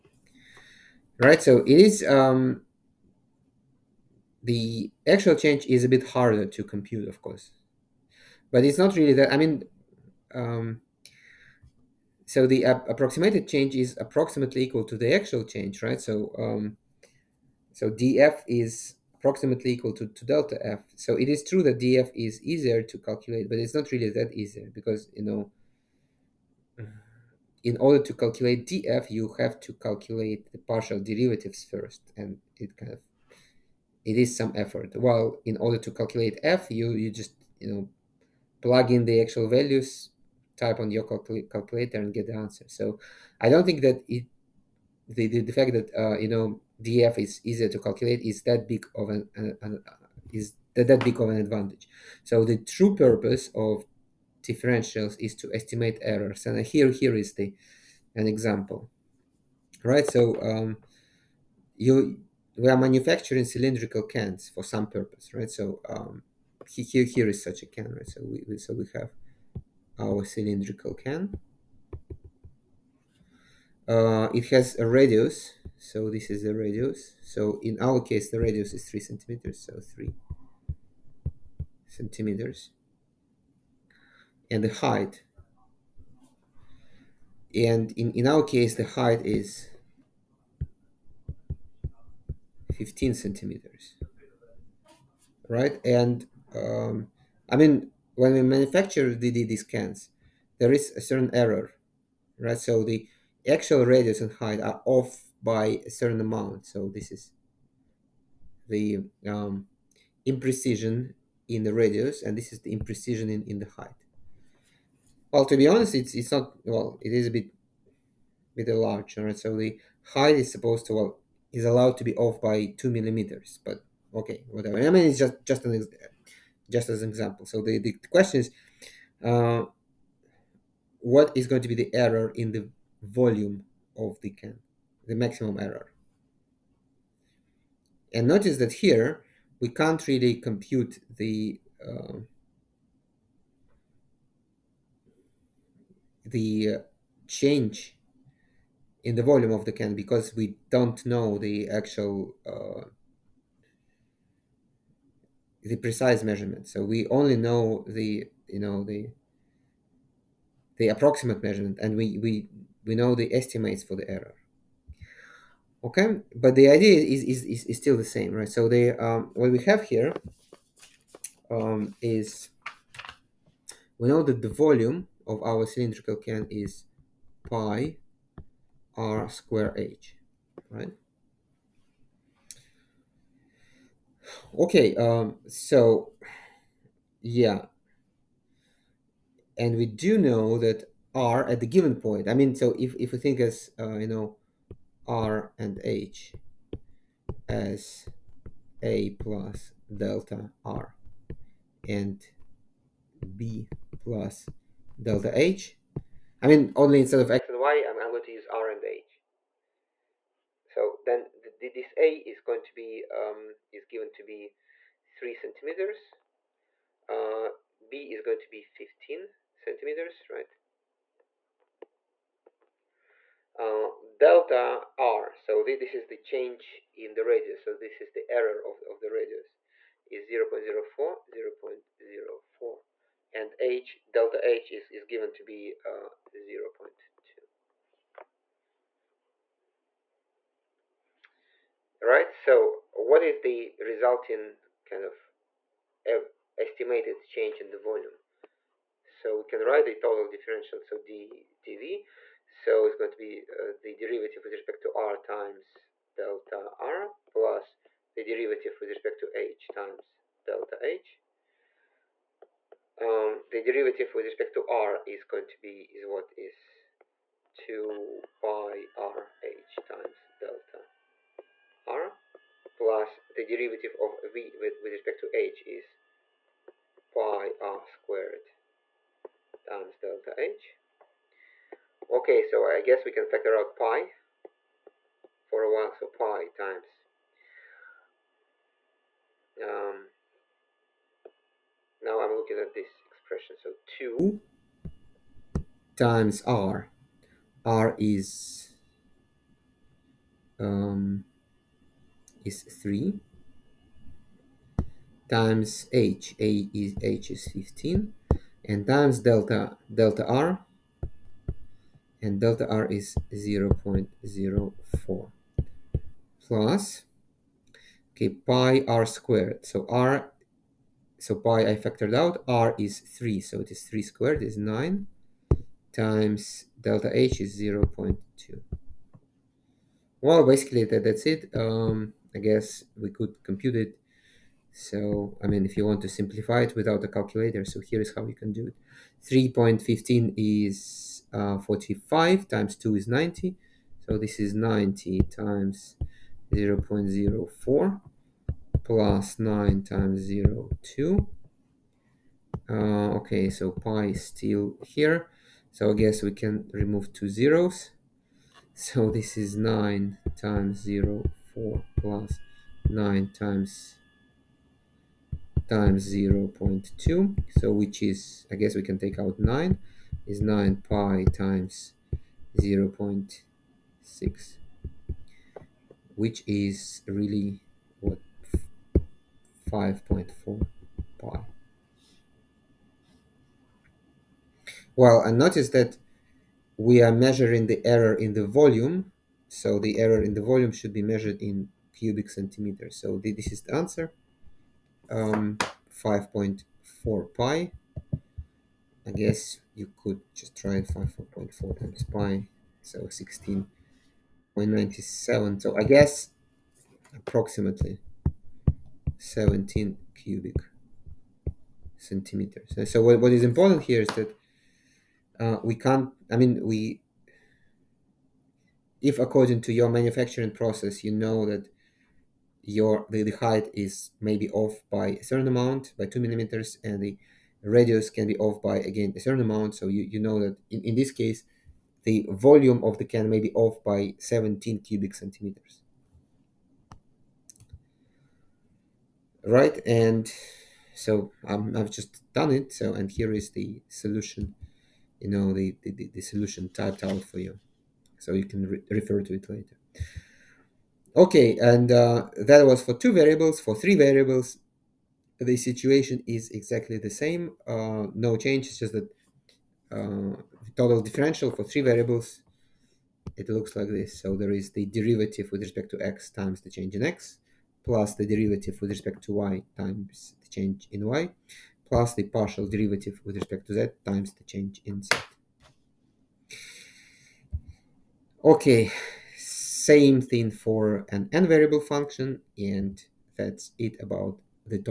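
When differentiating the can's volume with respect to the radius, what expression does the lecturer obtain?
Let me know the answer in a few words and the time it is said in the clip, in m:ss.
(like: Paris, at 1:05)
2 pi r h, at 4:27.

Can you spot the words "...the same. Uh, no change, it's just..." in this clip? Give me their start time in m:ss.
7:36.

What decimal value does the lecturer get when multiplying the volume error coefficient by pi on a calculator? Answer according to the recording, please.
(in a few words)
16.97.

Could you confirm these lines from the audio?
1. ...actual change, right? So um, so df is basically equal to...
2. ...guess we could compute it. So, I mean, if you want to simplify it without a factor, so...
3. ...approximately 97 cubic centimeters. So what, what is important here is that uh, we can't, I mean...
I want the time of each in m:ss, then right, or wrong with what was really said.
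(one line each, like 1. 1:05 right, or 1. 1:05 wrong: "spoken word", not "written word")
1. 0:15 wrong: "approximately", not "basically"
2. 5:32 wrong: "calculator", not "factor"
3. 6:47 wrong: "17", not "97".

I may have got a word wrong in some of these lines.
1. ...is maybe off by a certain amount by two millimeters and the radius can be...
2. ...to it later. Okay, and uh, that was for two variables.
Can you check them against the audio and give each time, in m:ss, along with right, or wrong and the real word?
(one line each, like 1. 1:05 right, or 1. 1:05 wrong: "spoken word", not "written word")
1. 7:03 right
2. 7:29 right.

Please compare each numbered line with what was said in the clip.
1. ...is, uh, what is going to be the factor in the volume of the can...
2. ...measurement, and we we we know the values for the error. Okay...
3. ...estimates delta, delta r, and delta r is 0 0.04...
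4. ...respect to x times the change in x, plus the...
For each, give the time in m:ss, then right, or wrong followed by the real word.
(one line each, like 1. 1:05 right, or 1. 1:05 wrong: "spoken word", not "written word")
1. 2:08 wrong: "error", not "factor"
2. 2:41 wrong: "estimates", not "values"
3. 5:08 wrong: "times", not "estimates"
4. 7:45 right.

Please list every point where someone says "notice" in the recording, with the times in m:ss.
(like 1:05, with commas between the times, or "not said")
2:18, 6:25.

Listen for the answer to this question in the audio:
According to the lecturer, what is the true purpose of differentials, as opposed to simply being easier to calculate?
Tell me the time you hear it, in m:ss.
0:55.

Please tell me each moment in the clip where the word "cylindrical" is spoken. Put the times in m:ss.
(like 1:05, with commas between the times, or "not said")
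1:03, 1:10, 2:55.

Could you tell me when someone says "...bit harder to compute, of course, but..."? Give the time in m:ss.
0:05.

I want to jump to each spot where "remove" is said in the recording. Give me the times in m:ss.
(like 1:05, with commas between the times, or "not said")
5:56.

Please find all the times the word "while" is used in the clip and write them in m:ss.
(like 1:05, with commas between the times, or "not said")
0:34, 4:45.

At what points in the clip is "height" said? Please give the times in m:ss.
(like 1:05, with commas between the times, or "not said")
1:24, 1:28, 1:44, 1:53, 2:00, 7:03.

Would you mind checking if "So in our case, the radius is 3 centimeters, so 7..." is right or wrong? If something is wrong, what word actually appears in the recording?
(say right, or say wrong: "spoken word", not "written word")
wrong: "3", not "7".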